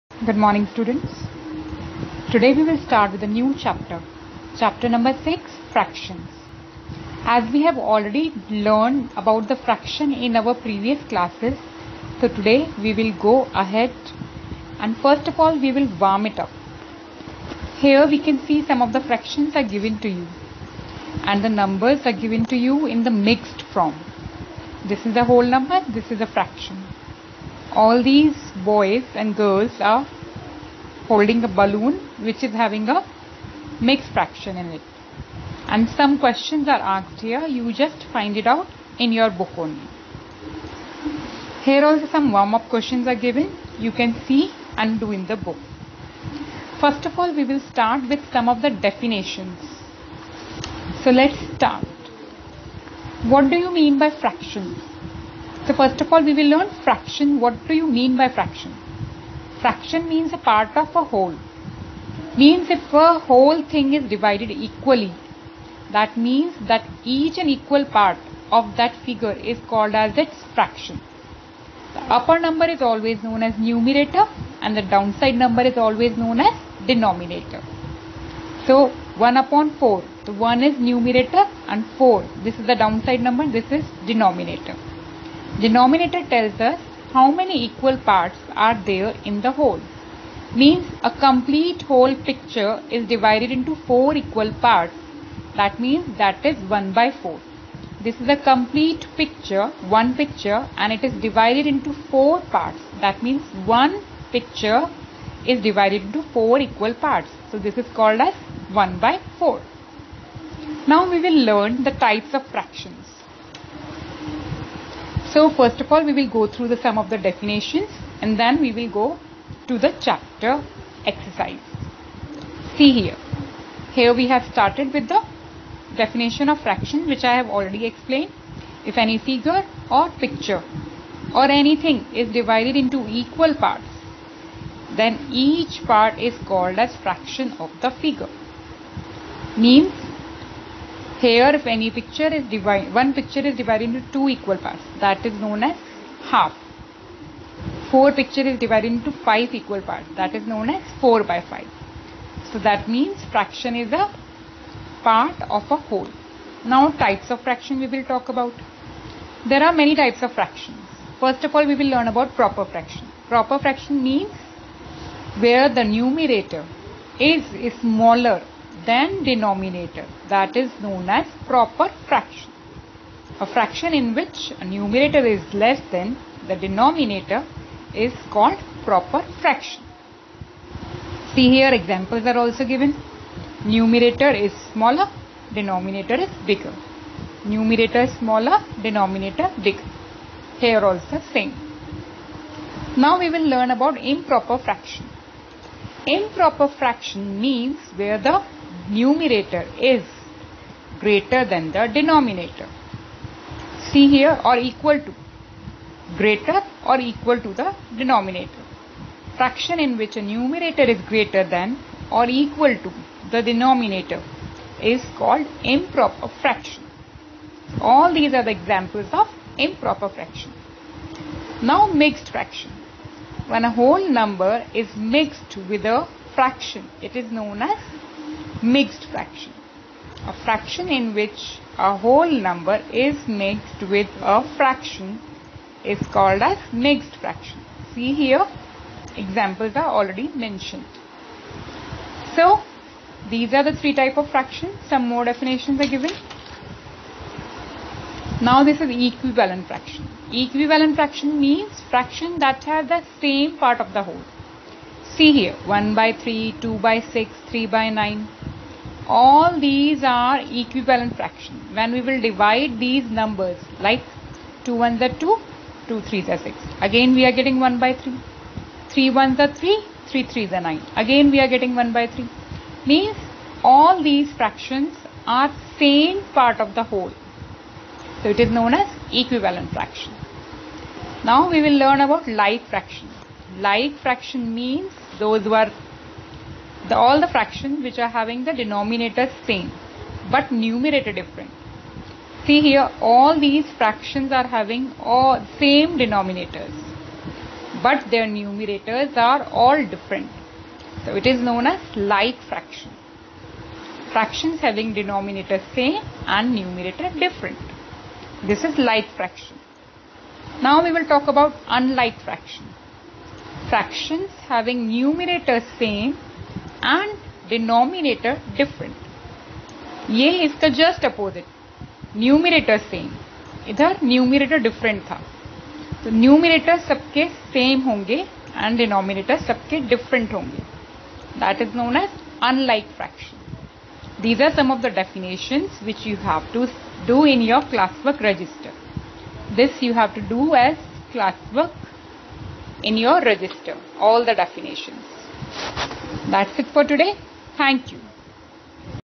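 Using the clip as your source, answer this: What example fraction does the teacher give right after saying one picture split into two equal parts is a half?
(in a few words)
4 by 5.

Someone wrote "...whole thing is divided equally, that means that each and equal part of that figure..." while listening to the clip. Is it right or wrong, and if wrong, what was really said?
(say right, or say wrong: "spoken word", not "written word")
right.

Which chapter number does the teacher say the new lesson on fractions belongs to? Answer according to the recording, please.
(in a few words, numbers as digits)
6.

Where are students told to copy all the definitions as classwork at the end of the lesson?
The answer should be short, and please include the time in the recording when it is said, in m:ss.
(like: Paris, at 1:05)
register, at 5:42.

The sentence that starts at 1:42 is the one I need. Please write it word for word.
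That means one picture is divided into 4 equal parts.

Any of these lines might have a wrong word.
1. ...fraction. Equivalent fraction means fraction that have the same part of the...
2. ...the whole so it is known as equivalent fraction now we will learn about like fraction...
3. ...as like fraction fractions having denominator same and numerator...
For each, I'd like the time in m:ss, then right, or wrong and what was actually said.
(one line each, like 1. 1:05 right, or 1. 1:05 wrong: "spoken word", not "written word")
1. 4:09 right
2. 4:36 right
3. 5:01 right.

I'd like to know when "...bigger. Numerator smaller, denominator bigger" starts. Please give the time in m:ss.
3:06.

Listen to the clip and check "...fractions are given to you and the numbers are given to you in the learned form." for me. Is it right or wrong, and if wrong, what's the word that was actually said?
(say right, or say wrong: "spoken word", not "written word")
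wrong: "mixed", not "learned".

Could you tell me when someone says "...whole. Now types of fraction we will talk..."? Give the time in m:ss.
2:35.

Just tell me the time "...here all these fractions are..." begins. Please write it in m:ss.
4:52.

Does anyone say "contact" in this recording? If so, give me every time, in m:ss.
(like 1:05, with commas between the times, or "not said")
not said.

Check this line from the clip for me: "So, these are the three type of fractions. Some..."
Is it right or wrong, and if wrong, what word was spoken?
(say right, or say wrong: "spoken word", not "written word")
right.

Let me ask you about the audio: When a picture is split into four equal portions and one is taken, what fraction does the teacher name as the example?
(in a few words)
1 by 4.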